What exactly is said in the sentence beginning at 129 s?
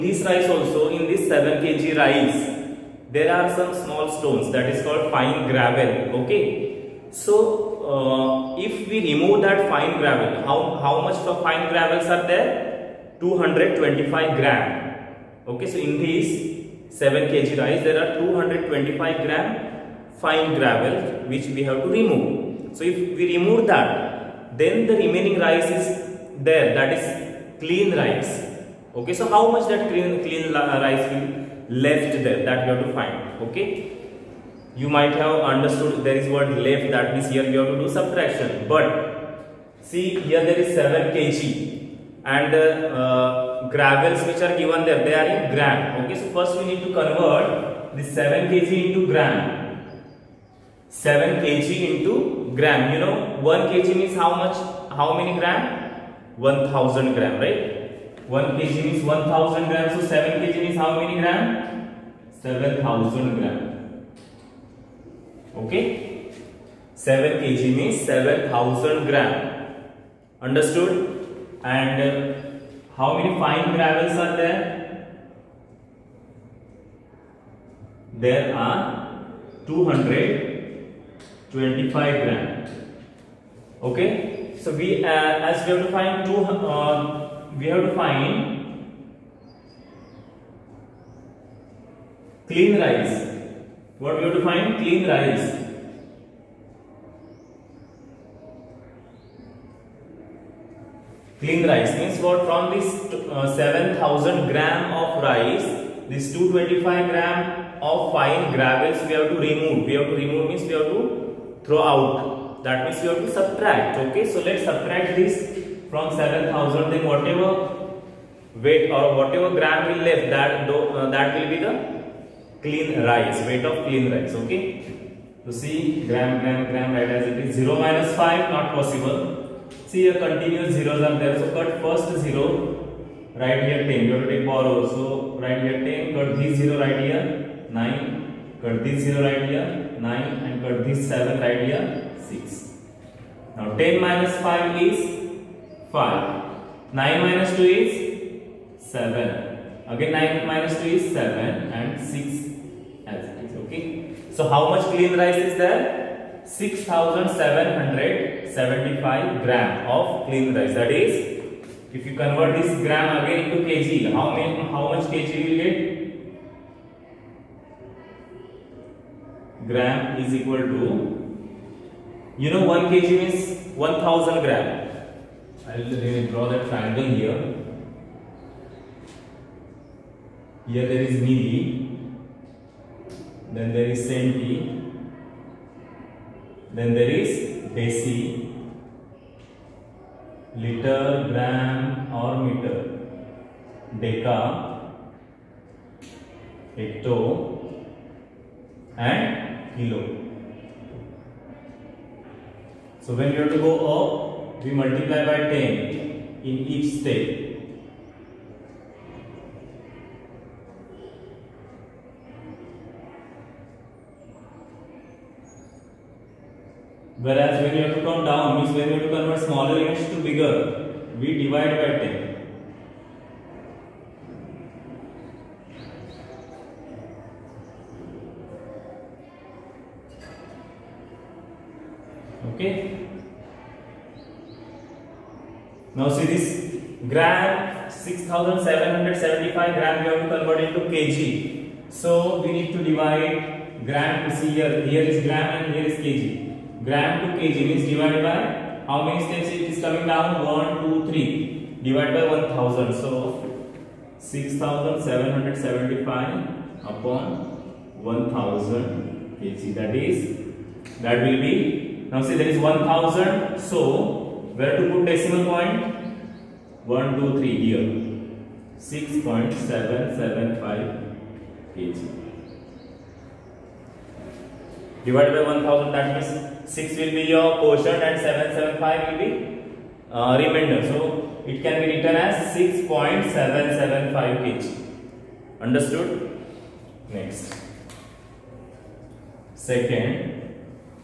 See a continuous zeros are there.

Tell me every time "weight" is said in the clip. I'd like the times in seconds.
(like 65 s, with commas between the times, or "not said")
118 s, 123 s.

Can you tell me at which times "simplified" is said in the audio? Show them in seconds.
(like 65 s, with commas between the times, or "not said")
not said.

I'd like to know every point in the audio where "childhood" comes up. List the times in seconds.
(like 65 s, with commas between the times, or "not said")
not said.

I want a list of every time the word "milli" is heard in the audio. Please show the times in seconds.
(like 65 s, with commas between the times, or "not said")
181 s.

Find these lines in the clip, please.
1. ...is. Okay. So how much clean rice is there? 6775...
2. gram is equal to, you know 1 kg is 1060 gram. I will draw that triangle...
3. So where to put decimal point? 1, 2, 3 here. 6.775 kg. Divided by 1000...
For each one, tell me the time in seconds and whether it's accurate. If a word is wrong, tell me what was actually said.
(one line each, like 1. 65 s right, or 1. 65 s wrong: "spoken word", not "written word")
1. 153 s right
2. 169 s wrong: "1000", not "1060"
3. 263 s right.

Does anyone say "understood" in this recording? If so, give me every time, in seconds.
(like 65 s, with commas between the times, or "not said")
35 s, 70 s, 285 s.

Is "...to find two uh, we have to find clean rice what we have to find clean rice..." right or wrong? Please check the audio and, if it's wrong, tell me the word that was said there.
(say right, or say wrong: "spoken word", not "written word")
right.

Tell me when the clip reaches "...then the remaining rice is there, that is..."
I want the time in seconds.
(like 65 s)
24 s.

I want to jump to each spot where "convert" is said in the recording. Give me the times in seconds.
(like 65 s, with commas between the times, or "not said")
47 s, 162 s, 219 s, 240 s.